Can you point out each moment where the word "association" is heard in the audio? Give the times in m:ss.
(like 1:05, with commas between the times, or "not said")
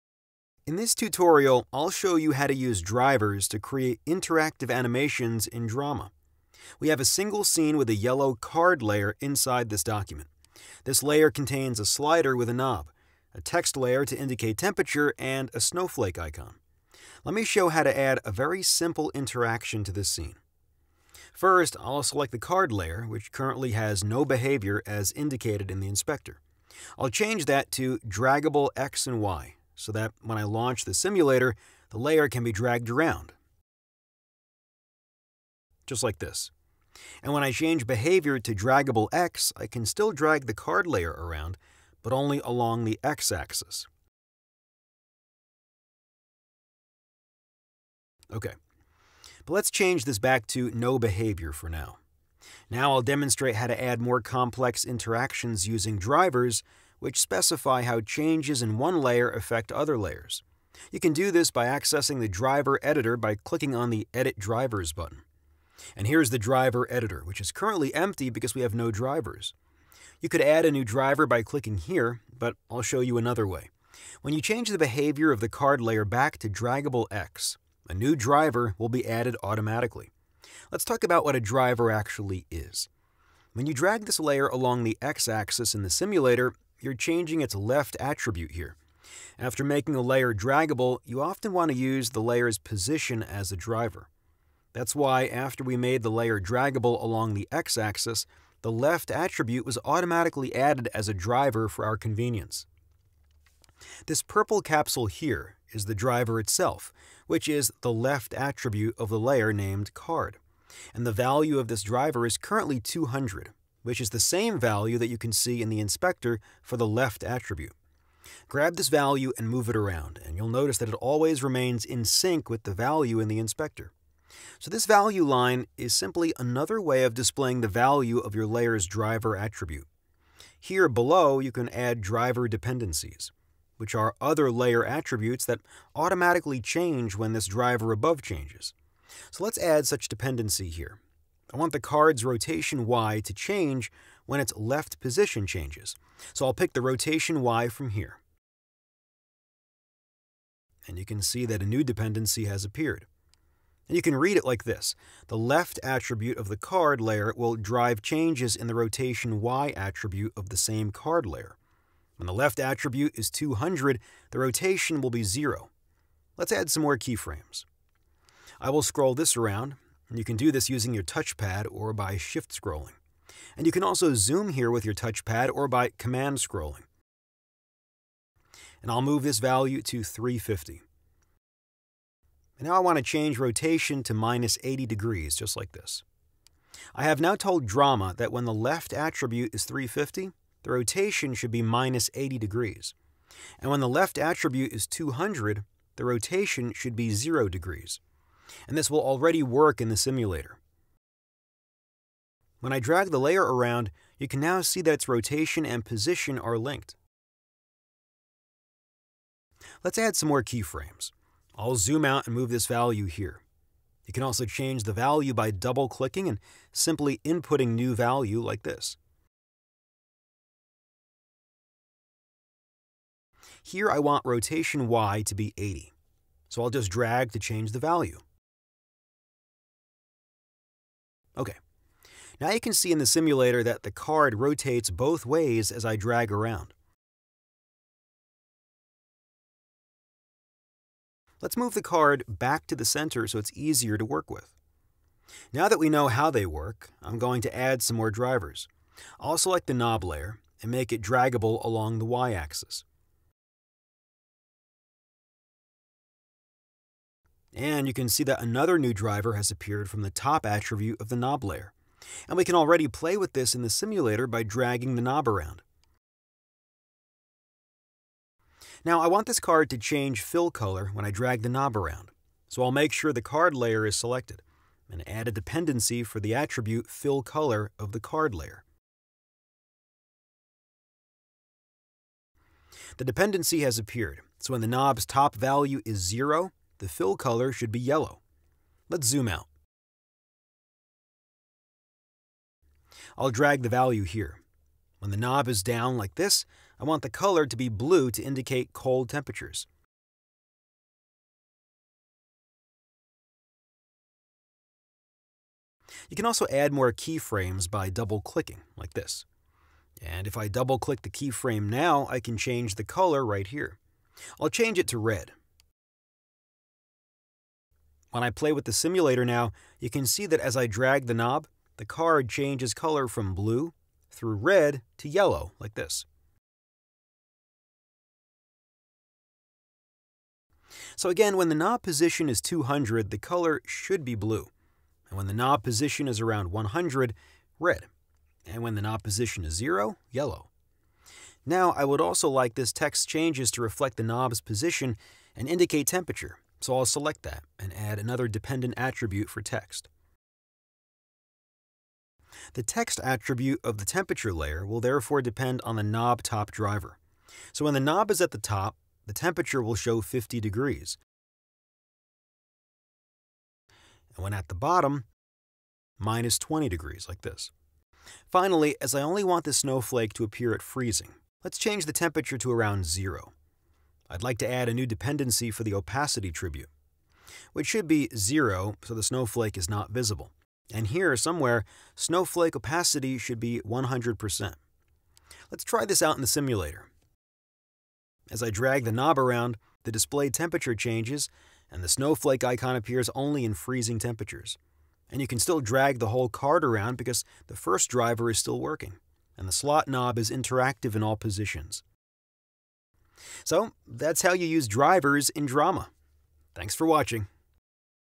not said.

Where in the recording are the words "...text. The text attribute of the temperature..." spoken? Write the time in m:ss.
5:49.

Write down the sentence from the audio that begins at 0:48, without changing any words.
Okay, but let's change this back to no behavior for now.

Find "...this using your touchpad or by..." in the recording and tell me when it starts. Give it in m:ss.
2:50.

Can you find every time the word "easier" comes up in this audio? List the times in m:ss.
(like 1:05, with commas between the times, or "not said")
4:03.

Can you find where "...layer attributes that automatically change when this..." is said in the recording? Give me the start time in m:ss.
2:14.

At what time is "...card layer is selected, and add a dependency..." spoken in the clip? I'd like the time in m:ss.
4:33.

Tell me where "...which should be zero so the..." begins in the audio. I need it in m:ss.
6:17.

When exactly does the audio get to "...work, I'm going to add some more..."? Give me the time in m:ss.
4:06.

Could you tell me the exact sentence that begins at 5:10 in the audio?
And if I double-click the keyframe now, I can change the color right here.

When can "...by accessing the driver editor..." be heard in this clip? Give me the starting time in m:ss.
1:01.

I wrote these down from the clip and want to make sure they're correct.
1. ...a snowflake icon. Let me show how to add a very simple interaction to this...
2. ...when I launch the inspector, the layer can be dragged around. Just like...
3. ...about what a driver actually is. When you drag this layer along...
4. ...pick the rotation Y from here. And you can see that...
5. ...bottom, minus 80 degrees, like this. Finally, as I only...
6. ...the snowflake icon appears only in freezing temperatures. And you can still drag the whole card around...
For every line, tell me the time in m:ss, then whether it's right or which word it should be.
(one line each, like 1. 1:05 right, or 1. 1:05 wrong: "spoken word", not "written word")
1. 0:15 right
2. 0:30 wrong: "simulator", not "inspector"
3. 1:21 right
4. 2:26 right
5. 6:04 wrong: "20", not "80"
6. 6:31 right.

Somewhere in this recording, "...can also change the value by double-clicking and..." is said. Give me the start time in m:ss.
3:34.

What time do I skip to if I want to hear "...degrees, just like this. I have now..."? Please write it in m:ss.
3:04.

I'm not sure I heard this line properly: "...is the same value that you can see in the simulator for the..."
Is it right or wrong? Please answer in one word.
wrong.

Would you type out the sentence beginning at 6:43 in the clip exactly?
So that's how you use drivers in drama.